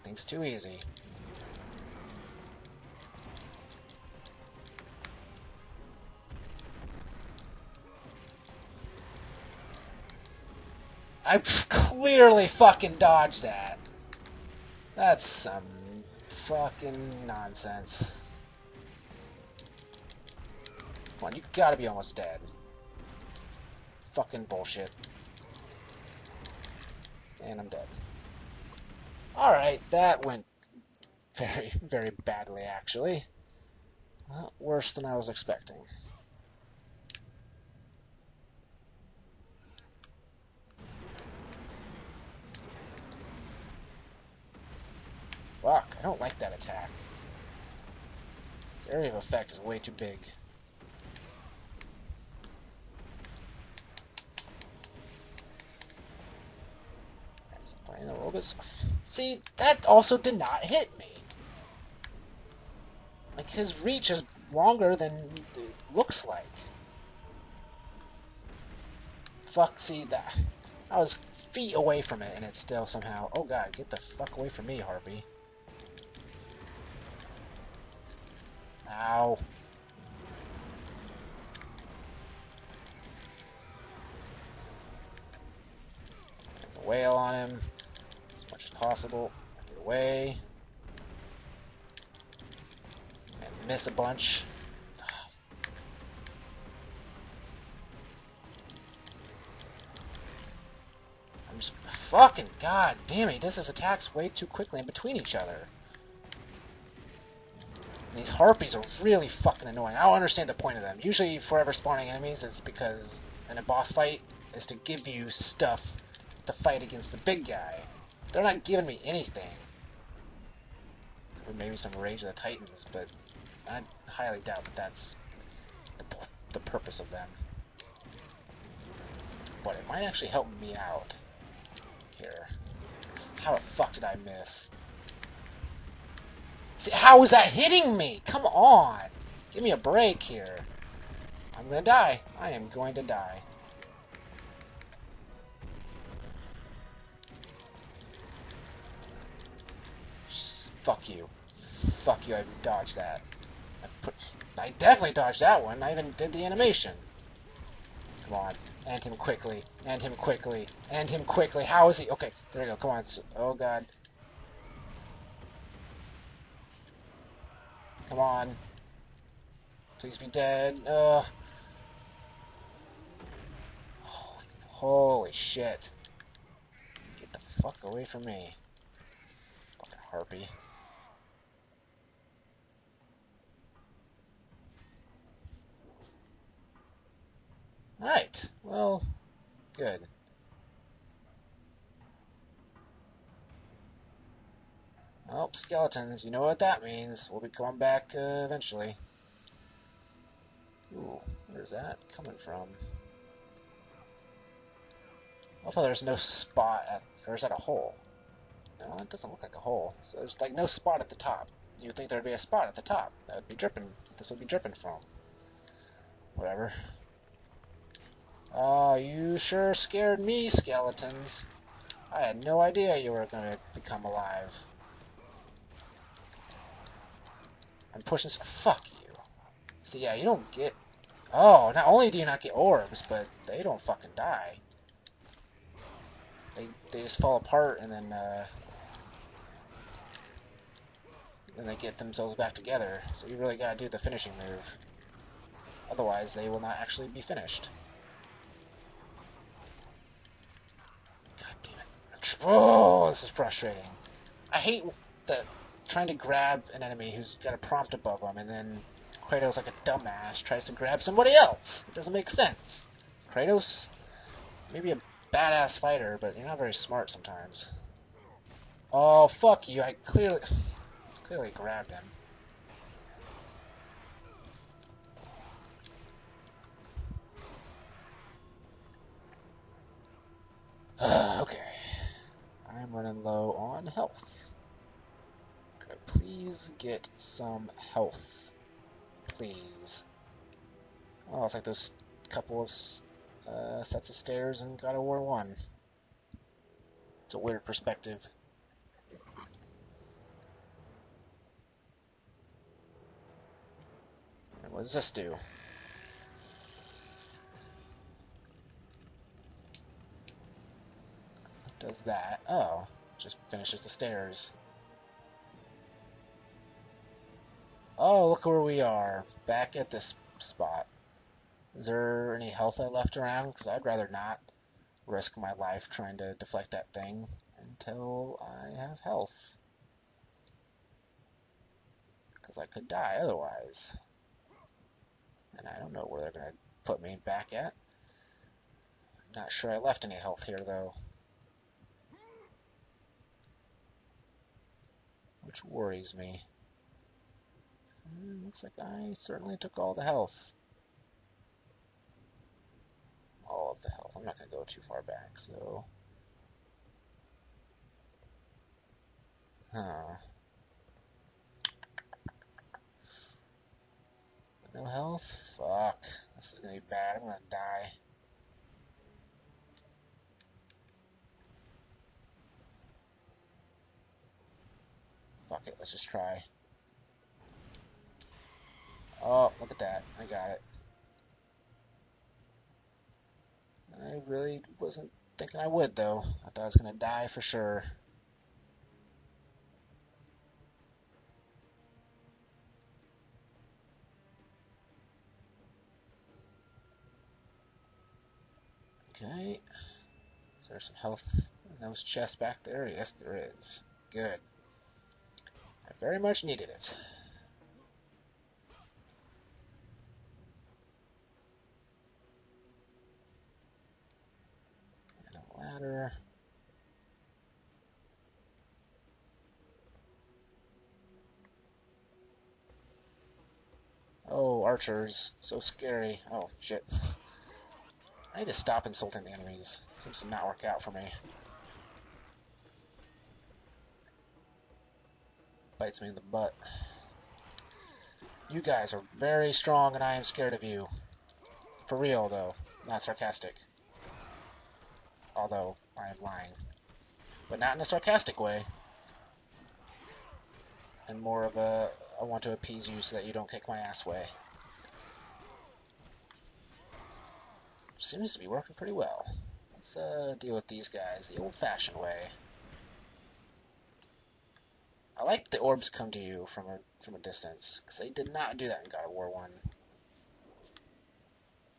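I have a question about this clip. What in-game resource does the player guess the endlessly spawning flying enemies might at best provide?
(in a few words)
Rage of the Titans.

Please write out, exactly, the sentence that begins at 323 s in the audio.
Because I'd rather not risk my life trying to deflect that thing until I have health.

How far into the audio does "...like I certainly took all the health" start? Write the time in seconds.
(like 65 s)
348 s.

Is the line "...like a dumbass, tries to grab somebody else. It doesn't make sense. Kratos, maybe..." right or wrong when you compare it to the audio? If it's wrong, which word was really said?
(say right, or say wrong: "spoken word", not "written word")
right.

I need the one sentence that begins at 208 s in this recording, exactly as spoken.
No, it doesn't look like a hole.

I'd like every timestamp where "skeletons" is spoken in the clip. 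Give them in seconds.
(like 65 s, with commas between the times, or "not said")
195 s, 220 s.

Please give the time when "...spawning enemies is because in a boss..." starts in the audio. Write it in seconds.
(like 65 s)
111 s.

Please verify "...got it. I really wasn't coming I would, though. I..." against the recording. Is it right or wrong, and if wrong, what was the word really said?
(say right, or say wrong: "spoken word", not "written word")
wrong: "thinking", not "coming".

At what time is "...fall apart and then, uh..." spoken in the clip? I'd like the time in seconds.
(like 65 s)
237 s.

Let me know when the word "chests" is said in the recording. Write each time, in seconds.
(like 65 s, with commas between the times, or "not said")
402 s.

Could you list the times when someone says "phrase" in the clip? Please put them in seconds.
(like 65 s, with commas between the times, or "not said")
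not said.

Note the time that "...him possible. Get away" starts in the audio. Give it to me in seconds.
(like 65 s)
87 s.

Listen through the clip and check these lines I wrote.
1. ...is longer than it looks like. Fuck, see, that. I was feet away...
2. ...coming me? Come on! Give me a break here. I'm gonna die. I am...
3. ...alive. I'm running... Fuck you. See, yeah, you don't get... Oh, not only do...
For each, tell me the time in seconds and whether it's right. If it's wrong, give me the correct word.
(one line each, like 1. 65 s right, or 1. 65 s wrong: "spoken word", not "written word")
1. 64 s right
2. 137 s wrong: "hitting", not "coming"
3. 224 s wrong: "pushing", not "running".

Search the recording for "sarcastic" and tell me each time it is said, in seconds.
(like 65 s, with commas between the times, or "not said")
443 s, 447 s.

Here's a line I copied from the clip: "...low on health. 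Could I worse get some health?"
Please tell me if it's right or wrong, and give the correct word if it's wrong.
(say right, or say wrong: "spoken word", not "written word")
wrong: "please", not "worse".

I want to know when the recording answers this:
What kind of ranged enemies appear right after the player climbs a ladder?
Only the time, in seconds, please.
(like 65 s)
424 s.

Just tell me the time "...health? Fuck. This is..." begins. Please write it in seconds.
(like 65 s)
364 s.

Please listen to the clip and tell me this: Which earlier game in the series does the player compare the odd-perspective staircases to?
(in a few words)
God of War 1.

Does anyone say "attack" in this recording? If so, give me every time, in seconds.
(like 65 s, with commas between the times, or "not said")
46 s, 103 s.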